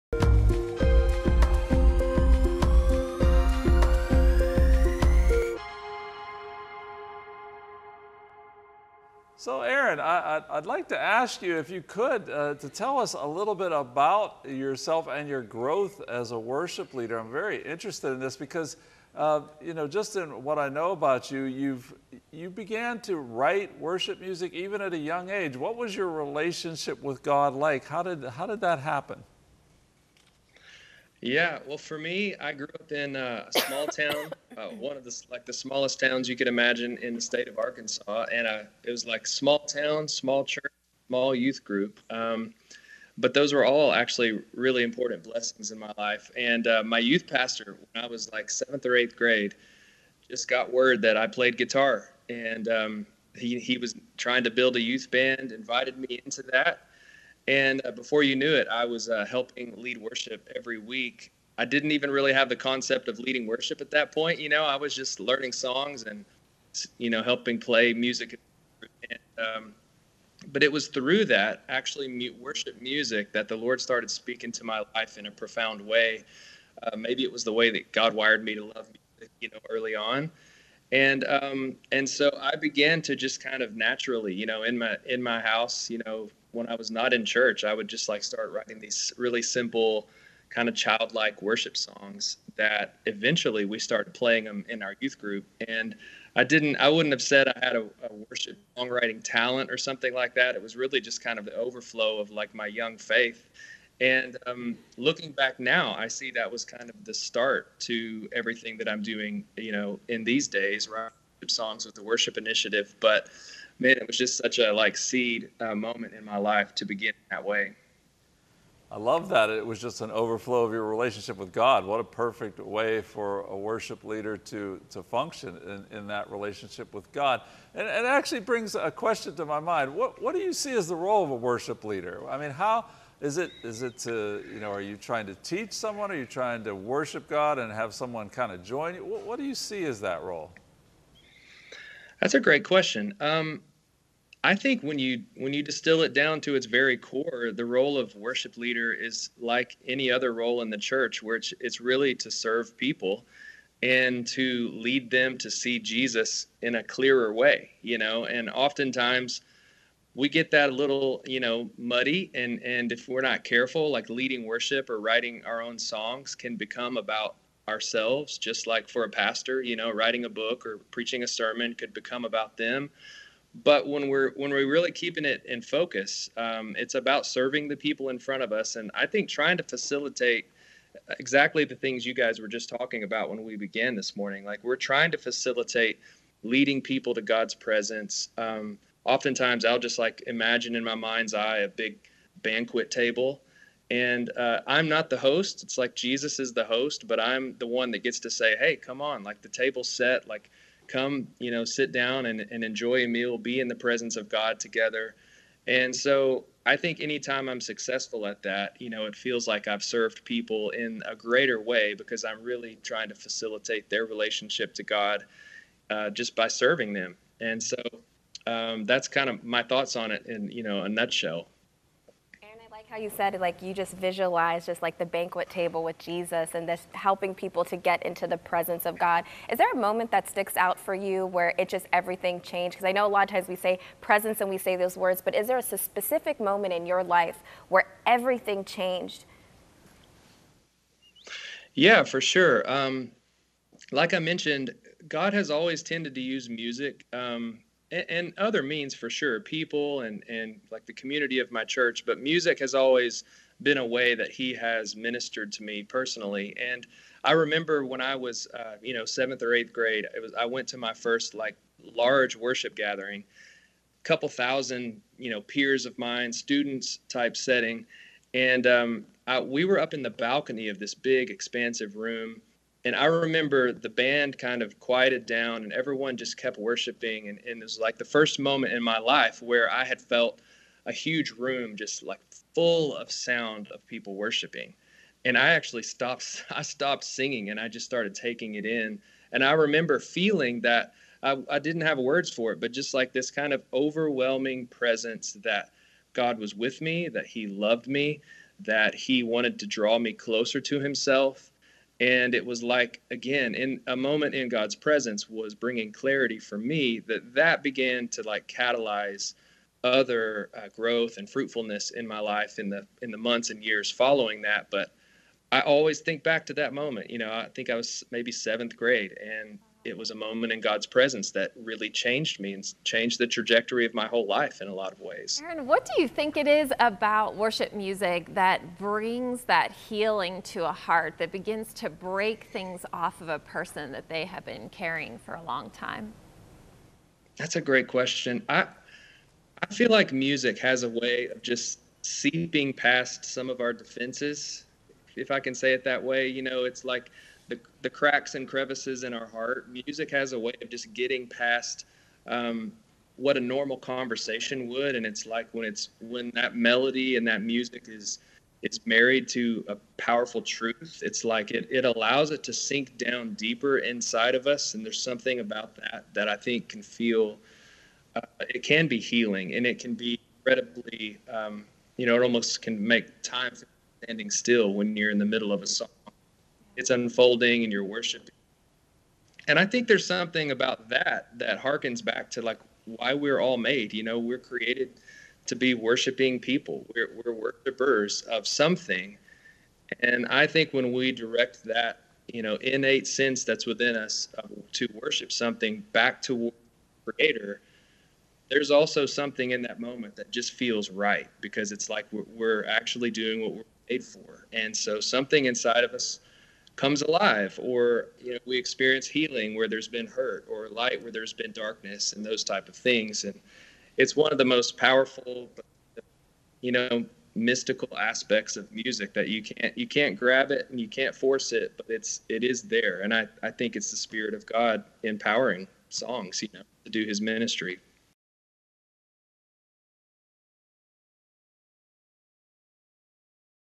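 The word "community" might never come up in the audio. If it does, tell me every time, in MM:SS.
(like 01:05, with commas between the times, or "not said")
04:10.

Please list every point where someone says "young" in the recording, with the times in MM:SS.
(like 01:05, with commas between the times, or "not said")
00:24, 01:42.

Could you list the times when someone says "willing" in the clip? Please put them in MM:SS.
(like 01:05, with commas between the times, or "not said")
not said.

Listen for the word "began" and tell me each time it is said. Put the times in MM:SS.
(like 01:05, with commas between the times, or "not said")
00:22, 01:22, 03:03, 05:07.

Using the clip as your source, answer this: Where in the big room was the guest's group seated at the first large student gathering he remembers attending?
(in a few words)
The balcony.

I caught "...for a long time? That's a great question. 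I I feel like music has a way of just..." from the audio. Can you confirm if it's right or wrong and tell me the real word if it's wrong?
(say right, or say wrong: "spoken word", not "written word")
right.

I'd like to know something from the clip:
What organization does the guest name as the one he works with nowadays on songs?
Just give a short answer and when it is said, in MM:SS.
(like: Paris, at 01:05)
The Worship Initiative, at 01:51.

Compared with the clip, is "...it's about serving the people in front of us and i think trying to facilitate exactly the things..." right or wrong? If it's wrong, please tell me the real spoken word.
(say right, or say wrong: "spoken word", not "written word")
right.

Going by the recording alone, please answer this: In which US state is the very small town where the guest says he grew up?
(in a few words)
Arkansas.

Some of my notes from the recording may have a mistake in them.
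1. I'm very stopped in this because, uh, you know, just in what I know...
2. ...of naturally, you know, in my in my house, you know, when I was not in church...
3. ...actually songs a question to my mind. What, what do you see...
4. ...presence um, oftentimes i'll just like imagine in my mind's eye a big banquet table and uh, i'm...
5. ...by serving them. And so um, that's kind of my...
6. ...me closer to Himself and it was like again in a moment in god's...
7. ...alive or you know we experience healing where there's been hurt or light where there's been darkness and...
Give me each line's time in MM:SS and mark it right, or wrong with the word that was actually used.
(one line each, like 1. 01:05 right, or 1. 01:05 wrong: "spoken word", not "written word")
1. 00:17 wrong: "interested", not "stopped"
2. 01:23 right
3. 02:08 wrong: "brings", not "songs"
4. 03:07 right
5. 03:36 right
6. 04:59 right
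7. 06:47 right.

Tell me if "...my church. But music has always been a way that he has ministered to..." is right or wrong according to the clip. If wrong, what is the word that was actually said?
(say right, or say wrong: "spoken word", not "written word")
right.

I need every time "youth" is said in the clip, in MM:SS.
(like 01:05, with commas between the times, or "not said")
00:41, 00:46, 00:54, 01:34.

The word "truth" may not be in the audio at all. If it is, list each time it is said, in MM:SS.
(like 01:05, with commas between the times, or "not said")
06:00.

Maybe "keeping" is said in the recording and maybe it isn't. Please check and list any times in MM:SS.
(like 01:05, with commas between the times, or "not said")
02:54.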